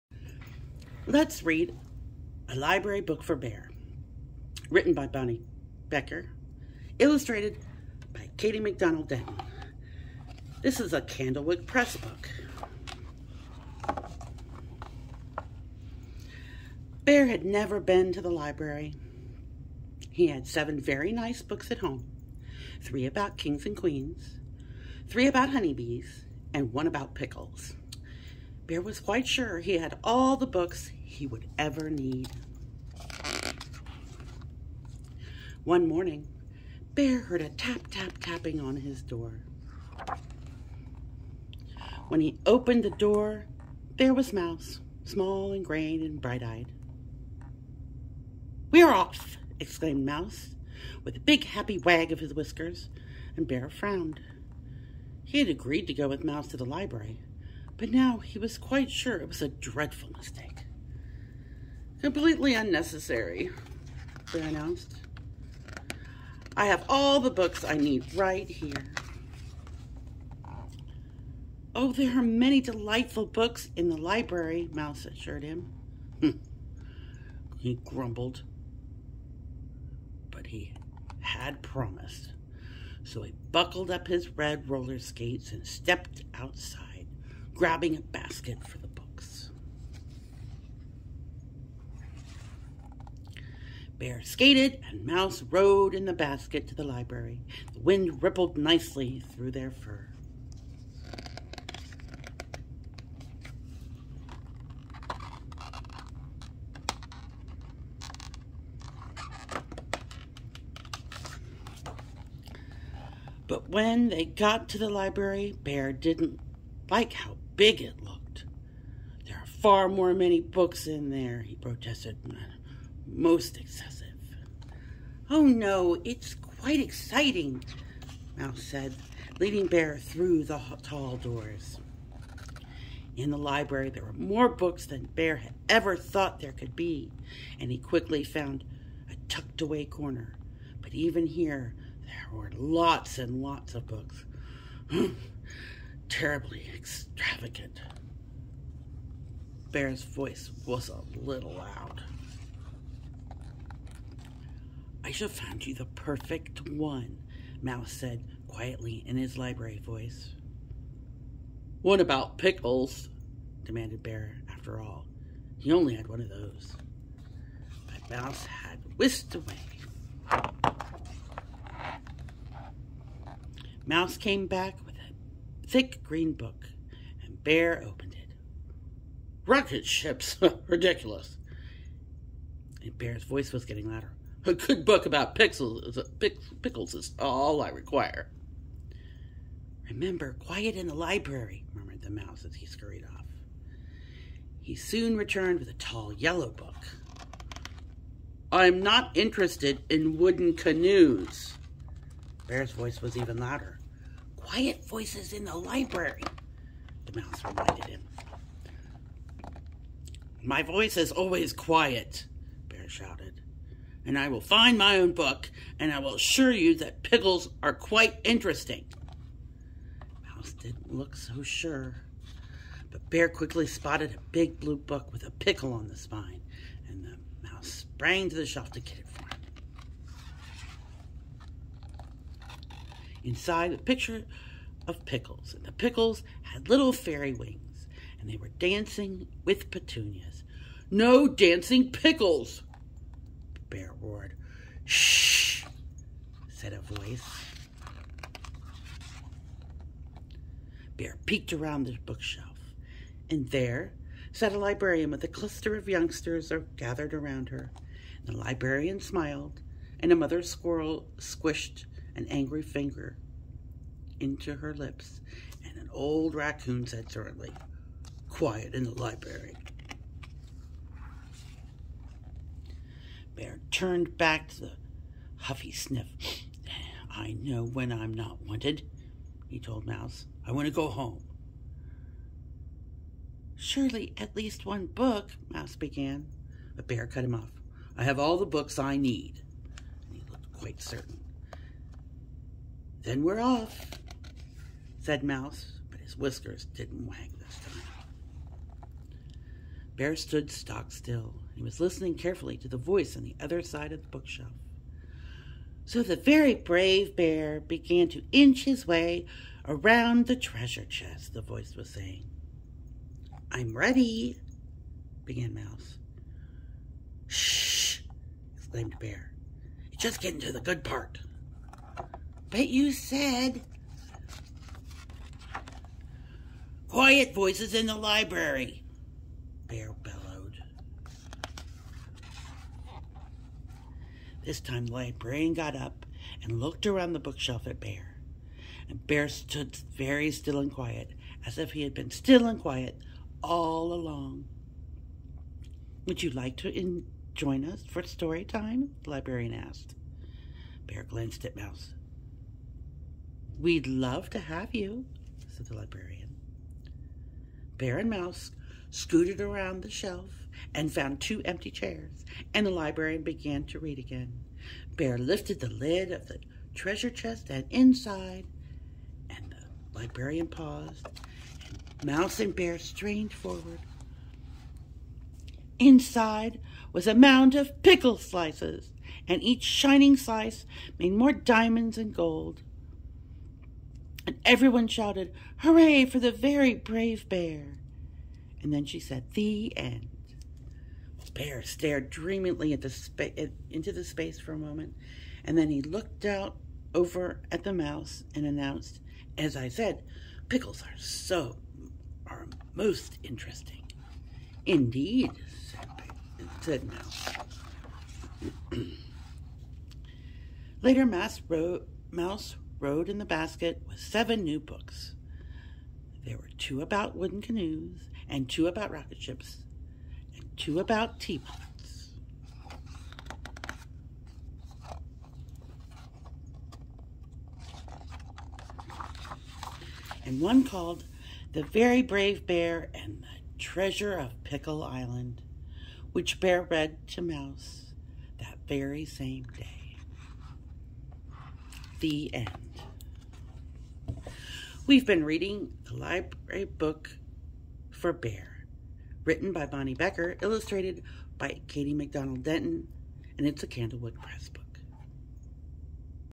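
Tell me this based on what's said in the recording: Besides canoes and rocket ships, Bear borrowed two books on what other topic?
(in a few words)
Teapots.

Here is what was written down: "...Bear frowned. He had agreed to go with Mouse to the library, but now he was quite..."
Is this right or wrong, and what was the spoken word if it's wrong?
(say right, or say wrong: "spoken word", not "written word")
right.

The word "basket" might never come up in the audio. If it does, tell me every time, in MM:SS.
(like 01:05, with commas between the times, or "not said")
01:28, 01:36, 06:53.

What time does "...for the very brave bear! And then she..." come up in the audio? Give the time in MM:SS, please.
06:26.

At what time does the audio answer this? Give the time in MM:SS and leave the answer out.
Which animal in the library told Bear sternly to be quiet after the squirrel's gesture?
04:26.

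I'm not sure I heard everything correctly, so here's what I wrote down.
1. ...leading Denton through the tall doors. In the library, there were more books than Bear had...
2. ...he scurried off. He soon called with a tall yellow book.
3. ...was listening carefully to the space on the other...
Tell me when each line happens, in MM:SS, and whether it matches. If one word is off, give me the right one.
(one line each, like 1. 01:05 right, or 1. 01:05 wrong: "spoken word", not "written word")
1. 02:09 wrong: "Bear", not "Denton"
2. 03:12 wrong: "returned", not "called"
3. 05:01 wrong: "voice", not "space".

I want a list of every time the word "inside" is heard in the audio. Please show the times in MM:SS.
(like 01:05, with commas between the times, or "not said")
03:53, 06:07, 06:15.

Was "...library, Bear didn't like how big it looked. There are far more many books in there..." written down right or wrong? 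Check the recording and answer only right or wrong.
right.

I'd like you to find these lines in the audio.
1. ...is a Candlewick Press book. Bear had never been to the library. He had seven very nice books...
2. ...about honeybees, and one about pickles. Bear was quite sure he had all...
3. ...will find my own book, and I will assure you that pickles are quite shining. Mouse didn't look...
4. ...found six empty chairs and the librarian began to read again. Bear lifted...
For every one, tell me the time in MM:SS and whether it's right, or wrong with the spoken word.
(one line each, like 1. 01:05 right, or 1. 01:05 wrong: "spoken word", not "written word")
1. 00:10 right
2. 00:25 right
3. 03:34 wrong: "interesting", not "shining"
4. 06:00 wrong: "two", not "six".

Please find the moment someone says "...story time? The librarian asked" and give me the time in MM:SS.
05:48.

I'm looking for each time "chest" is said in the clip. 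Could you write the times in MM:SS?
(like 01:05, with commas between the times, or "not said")
05:10, 06:07.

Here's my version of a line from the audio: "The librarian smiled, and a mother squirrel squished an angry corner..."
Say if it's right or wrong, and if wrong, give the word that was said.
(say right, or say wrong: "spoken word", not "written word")
wrong: "finger", not "corner".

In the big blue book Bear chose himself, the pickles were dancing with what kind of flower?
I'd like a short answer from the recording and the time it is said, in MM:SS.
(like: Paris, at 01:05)
Petunias, at 03:59.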